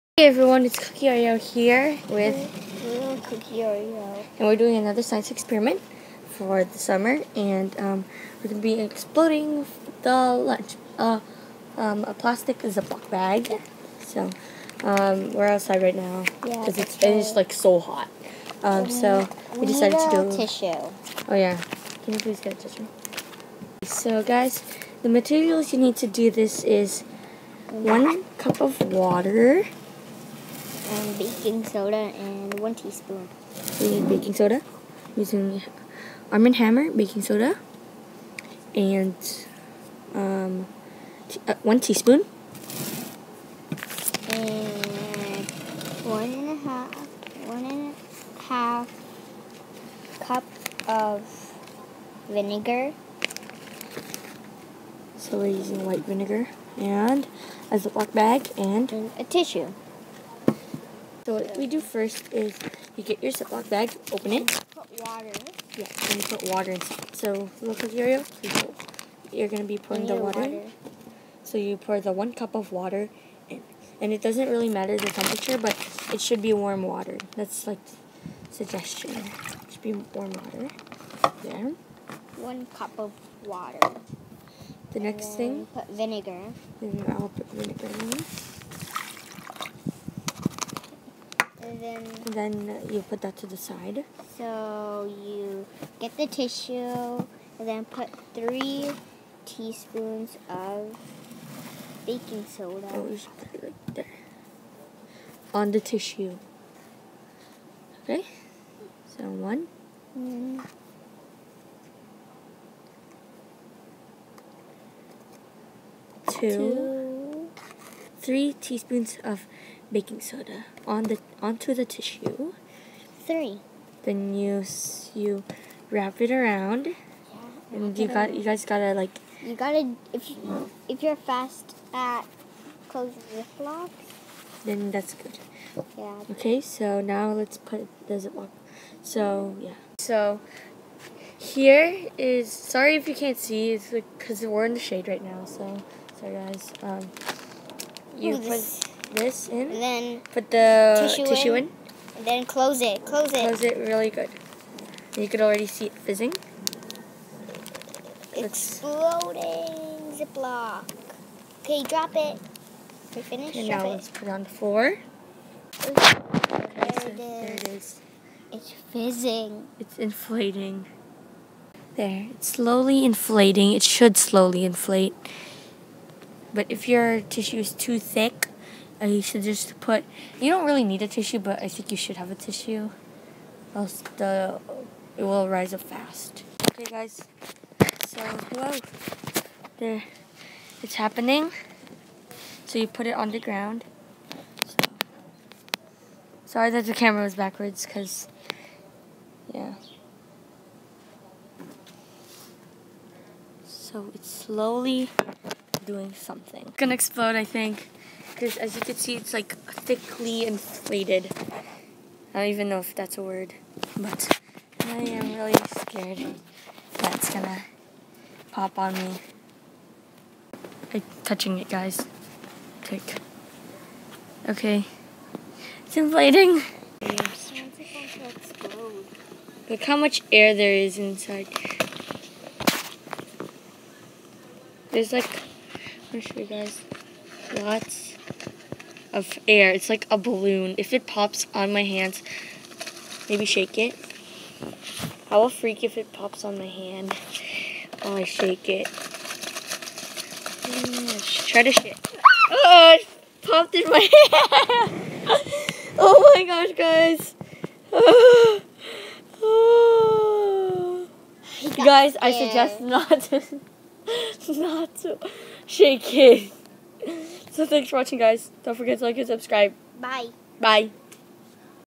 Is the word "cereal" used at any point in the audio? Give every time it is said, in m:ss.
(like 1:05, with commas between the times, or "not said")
1:07.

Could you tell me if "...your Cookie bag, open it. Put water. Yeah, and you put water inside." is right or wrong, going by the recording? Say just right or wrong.
wrong.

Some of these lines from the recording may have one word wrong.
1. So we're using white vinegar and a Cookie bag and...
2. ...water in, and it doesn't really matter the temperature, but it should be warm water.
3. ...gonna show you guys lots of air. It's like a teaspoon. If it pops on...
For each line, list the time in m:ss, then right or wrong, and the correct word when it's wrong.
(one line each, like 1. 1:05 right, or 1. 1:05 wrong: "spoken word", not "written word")
1. 0:55 wrong: "Ziploc", not "Cookie"
2. 1:12 right
3. 3:56 wrong: "balloon", not "teaspoon".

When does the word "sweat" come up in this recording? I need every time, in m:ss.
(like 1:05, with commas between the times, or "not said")
not said.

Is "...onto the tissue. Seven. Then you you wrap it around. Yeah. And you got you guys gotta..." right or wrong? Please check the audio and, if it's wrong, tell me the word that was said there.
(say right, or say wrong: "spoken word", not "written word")
wrong: "Three", not "Seven".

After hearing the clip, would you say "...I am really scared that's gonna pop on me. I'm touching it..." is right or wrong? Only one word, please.
right.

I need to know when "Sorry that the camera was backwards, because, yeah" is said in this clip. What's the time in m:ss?
3:16.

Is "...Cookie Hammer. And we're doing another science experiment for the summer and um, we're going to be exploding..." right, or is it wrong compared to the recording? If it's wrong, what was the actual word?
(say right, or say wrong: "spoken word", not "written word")
wrong: "Oreo", not "Hammer".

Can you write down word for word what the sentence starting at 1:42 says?
Oh, you should put it right there.